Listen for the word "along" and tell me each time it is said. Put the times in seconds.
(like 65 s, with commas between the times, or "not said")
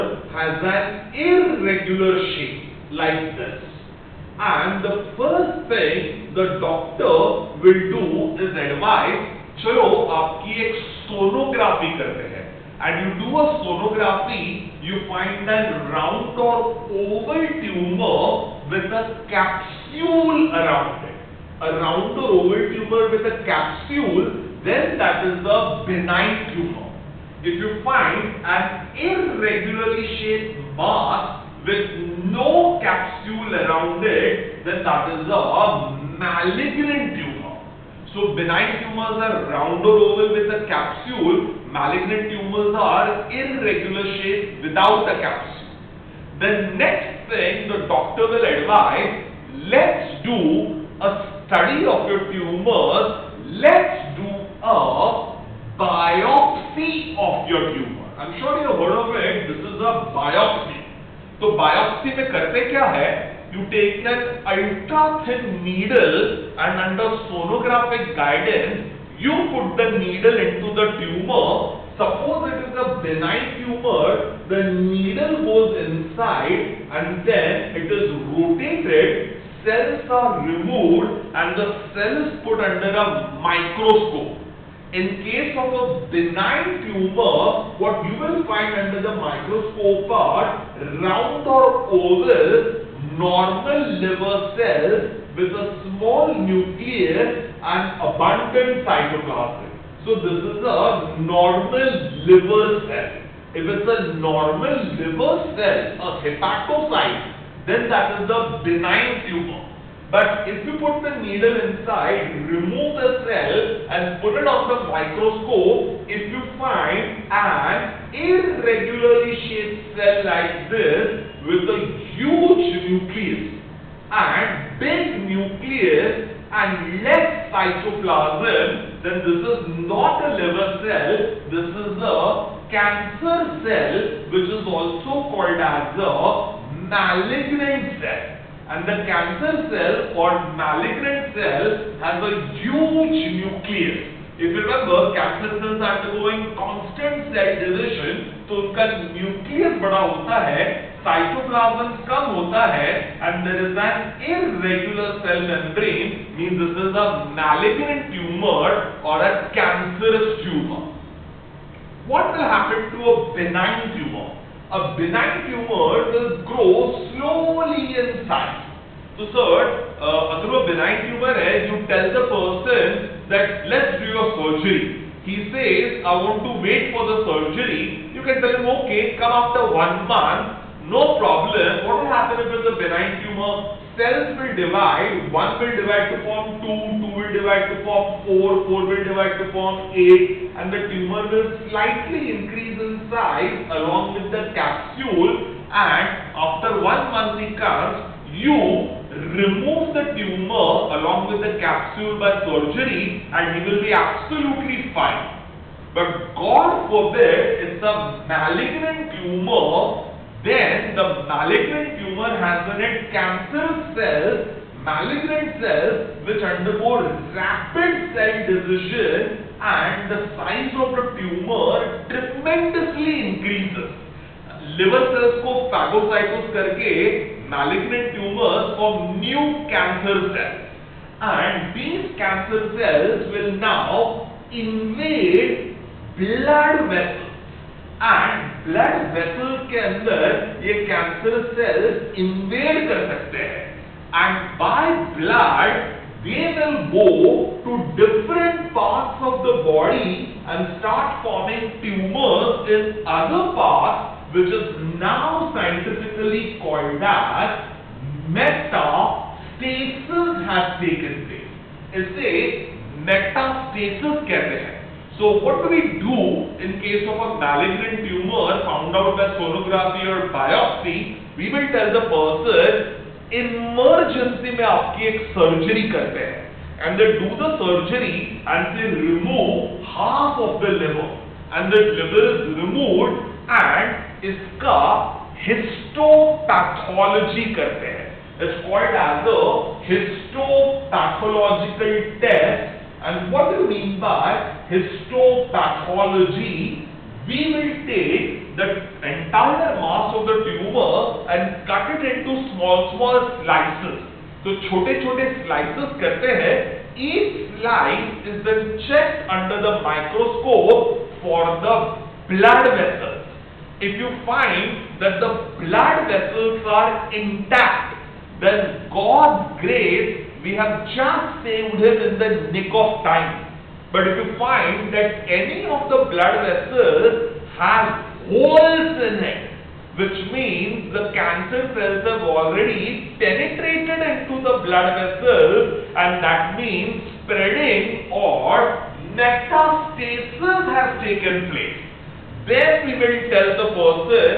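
193 s, 200 s.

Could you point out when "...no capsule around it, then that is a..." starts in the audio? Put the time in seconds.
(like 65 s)
32 s.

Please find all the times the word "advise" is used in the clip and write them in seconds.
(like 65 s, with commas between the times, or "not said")
8 s, 48 s.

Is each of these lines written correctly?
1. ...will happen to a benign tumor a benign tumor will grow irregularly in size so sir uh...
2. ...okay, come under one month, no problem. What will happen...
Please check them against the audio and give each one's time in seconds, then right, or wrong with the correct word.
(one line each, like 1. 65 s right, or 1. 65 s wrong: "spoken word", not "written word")
1. 162 s wrong: "slowly", not "irregularly"
2. 178 s wrong: "after", not "under".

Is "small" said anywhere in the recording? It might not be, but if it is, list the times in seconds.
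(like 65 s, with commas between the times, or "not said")
95 s.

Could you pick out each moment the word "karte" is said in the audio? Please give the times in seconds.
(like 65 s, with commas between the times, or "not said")
11 s, 275 s.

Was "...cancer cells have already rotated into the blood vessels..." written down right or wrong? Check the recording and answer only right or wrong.
wrong.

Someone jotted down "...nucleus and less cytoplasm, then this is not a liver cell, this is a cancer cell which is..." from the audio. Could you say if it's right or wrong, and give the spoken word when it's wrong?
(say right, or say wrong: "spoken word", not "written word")
right.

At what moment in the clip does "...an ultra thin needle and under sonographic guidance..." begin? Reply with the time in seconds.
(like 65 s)
64 s.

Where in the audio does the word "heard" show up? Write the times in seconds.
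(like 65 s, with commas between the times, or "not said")
58 s.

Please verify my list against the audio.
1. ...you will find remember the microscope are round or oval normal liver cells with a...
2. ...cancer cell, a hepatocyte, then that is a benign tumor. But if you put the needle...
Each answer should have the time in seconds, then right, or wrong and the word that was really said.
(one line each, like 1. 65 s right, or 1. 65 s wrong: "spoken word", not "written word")
1. 88 s wrong: "under", not "remember"
2. 104 s wrong: "liver", not "cancer".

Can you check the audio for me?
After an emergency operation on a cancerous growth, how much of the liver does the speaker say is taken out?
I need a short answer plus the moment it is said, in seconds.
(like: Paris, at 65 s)
half, at 279 s.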